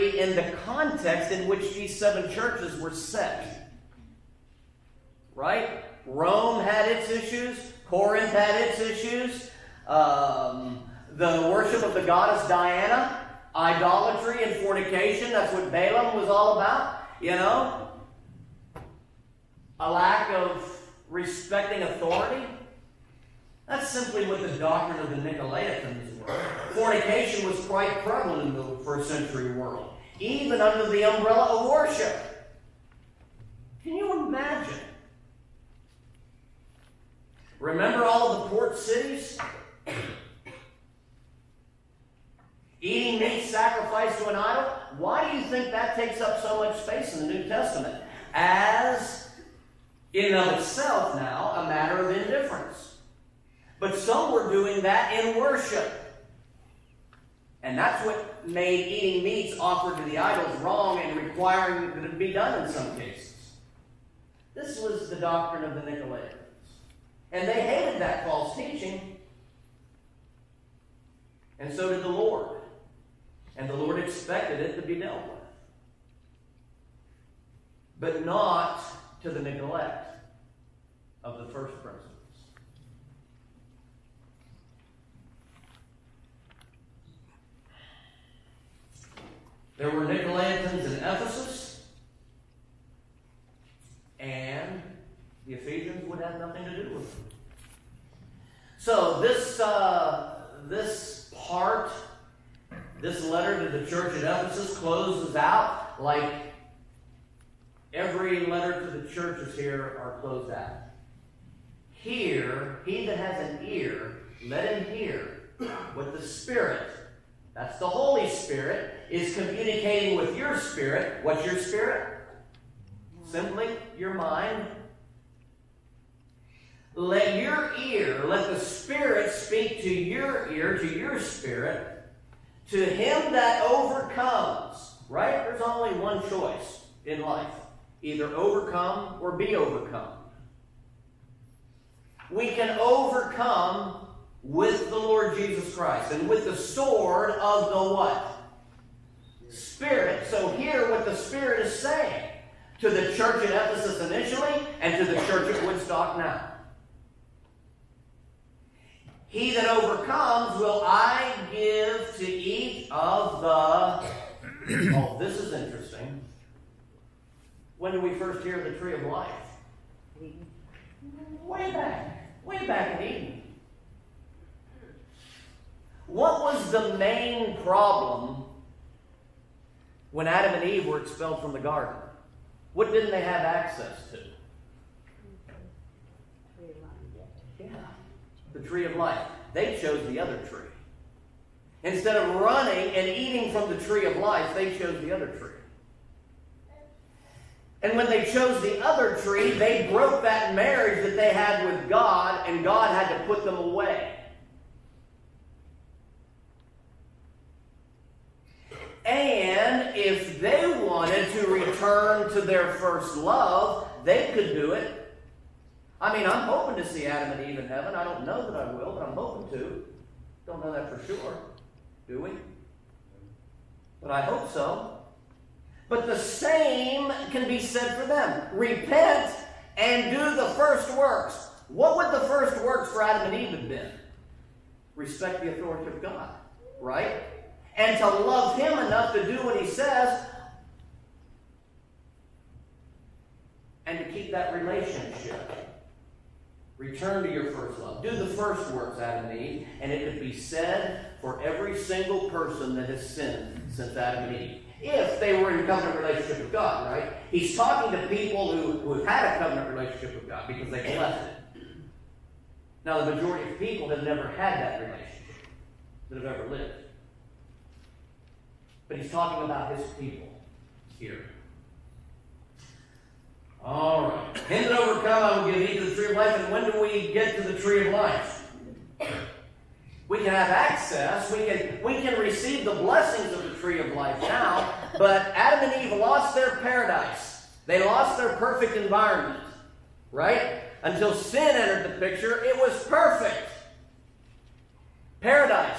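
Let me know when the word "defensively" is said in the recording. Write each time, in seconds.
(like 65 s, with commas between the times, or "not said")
not said.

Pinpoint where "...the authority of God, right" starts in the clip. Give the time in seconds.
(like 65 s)
235 s.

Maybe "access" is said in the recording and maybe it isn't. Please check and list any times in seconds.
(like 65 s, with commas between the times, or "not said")
183 s, 280 s.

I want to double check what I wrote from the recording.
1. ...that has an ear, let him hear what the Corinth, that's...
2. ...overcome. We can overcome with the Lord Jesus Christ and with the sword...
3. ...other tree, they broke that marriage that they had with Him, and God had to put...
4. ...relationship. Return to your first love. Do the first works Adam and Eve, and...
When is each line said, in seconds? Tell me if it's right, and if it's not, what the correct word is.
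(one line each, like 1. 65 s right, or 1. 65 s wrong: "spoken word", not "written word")
1. 113 s wrong: "Spirit", not "Corinth"
2. 139 s right
3. 198 s wrong: "God", not "Him"
4. 244 s right.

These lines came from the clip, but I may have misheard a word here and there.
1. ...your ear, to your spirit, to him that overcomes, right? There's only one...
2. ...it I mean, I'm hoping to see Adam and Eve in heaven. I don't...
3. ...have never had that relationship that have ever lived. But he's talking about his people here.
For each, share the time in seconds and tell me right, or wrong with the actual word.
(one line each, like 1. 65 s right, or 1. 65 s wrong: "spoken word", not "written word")
1. 129 s right
2. 214 s right
3. 263 s right.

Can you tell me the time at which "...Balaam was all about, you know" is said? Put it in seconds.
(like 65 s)
15 s.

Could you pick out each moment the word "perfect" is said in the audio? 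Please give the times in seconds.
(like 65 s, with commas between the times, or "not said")
288 s, 292 s.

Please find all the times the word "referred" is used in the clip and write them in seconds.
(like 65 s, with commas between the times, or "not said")
not said.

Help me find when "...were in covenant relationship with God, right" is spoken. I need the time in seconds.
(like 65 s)
255 s.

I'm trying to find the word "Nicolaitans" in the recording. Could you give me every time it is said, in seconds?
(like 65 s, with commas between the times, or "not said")
25 s, 65 s, 90 s.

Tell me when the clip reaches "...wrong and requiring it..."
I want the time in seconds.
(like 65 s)
60 s.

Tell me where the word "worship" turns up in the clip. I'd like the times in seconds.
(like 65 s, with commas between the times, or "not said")
11 s, 31 s, 55 s.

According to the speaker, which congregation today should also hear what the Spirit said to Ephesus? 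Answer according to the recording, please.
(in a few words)
Woodstock.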